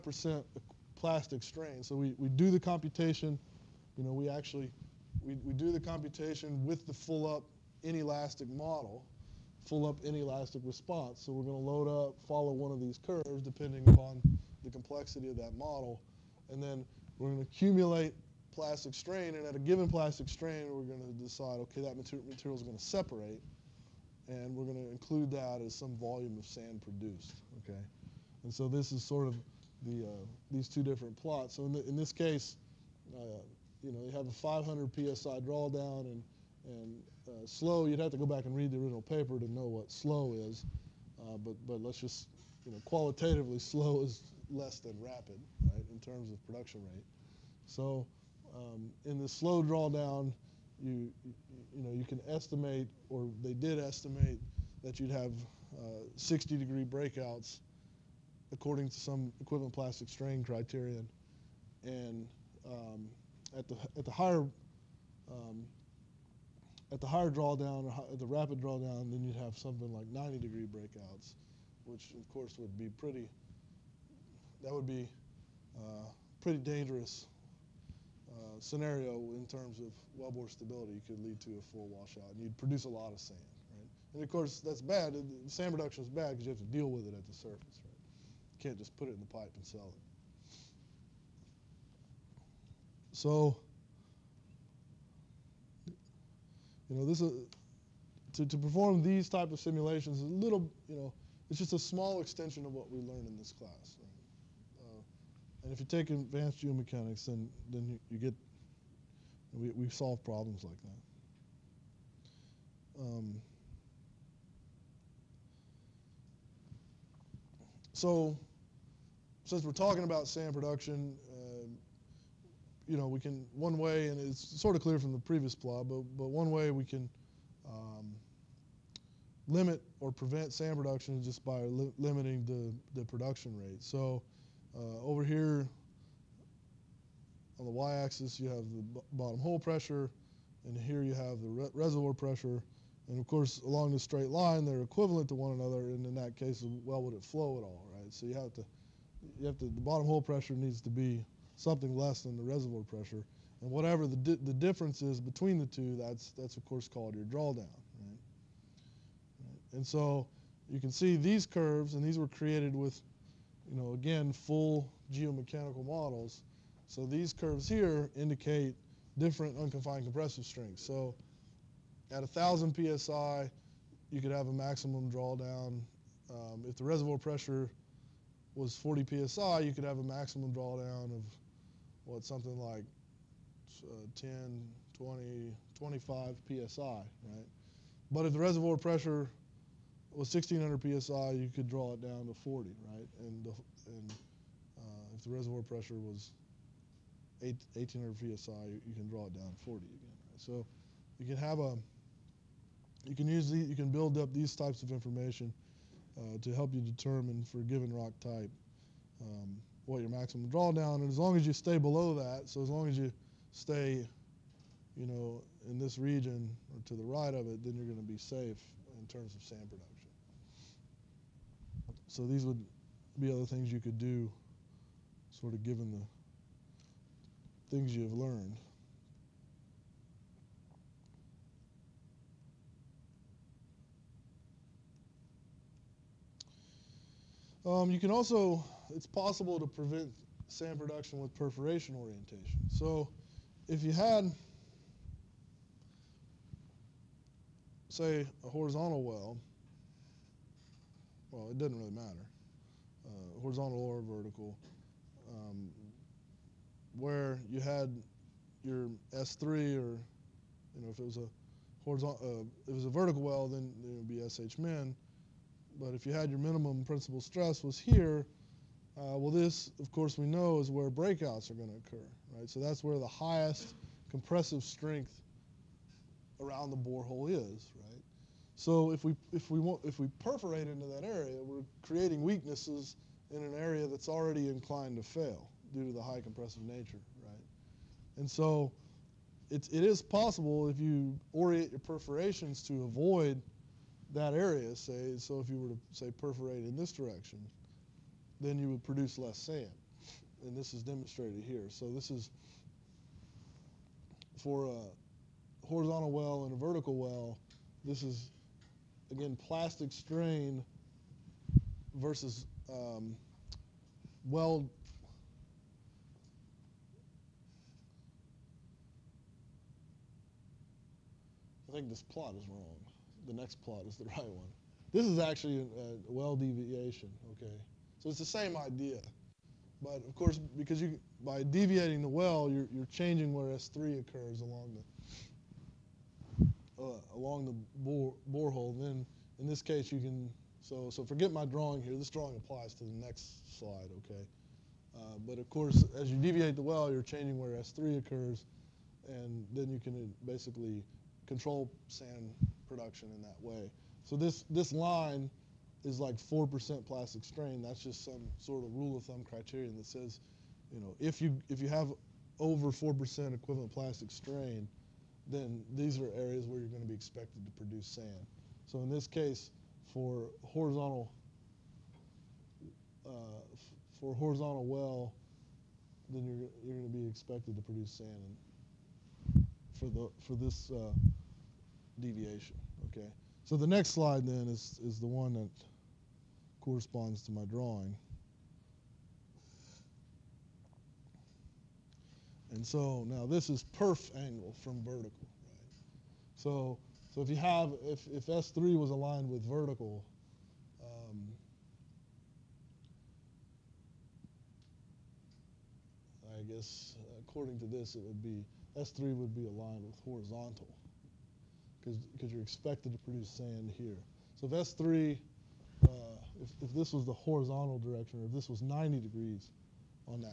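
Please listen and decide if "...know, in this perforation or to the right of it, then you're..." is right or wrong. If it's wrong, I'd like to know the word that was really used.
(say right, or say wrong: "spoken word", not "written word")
wrong: "region", not "perforation".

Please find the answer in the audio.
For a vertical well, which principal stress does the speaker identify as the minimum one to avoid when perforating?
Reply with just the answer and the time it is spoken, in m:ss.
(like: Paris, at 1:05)
SH min, at 4:24.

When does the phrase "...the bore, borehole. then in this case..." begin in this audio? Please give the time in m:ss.
5:37.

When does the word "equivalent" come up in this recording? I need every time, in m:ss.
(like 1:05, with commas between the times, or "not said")
0:59, 2:24, 6:03.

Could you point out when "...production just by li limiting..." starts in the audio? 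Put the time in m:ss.
2:10.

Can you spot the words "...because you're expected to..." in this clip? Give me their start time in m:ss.
6:52.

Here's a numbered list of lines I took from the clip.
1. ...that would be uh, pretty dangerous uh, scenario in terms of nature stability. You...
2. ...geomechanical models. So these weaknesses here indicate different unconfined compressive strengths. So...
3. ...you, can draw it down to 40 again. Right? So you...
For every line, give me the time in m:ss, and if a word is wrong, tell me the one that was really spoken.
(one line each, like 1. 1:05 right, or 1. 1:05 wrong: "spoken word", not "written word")
1. 1:14 wrong: "wellbore", not "nature"
2. 2:45 wrong: "curves", not "weaknesses"
3. 3:18 right.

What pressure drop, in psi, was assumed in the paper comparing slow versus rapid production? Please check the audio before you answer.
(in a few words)
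500 psi.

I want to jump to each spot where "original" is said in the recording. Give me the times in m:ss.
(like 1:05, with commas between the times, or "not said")
0:38.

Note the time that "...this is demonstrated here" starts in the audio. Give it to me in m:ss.
5:00.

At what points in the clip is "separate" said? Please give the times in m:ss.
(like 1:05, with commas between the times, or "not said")
0:22.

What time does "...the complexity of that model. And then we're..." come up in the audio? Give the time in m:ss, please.
0:14.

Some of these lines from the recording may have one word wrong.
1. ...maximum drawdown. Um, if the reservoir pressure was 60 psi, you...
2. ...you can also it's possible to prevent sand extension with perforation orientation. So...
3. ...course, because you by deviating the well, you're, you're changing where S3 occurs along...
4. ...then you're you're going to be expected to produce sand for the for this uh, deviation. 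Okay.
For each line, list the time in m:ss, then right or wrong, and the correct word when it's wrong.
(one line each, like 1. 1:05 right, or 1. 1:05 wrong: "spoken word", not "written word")
1. 2:54 wrong: "40", not "60"
2. 3:57 wrong: "production", not "extension"
3. 5:30 right
4. 6:16 right.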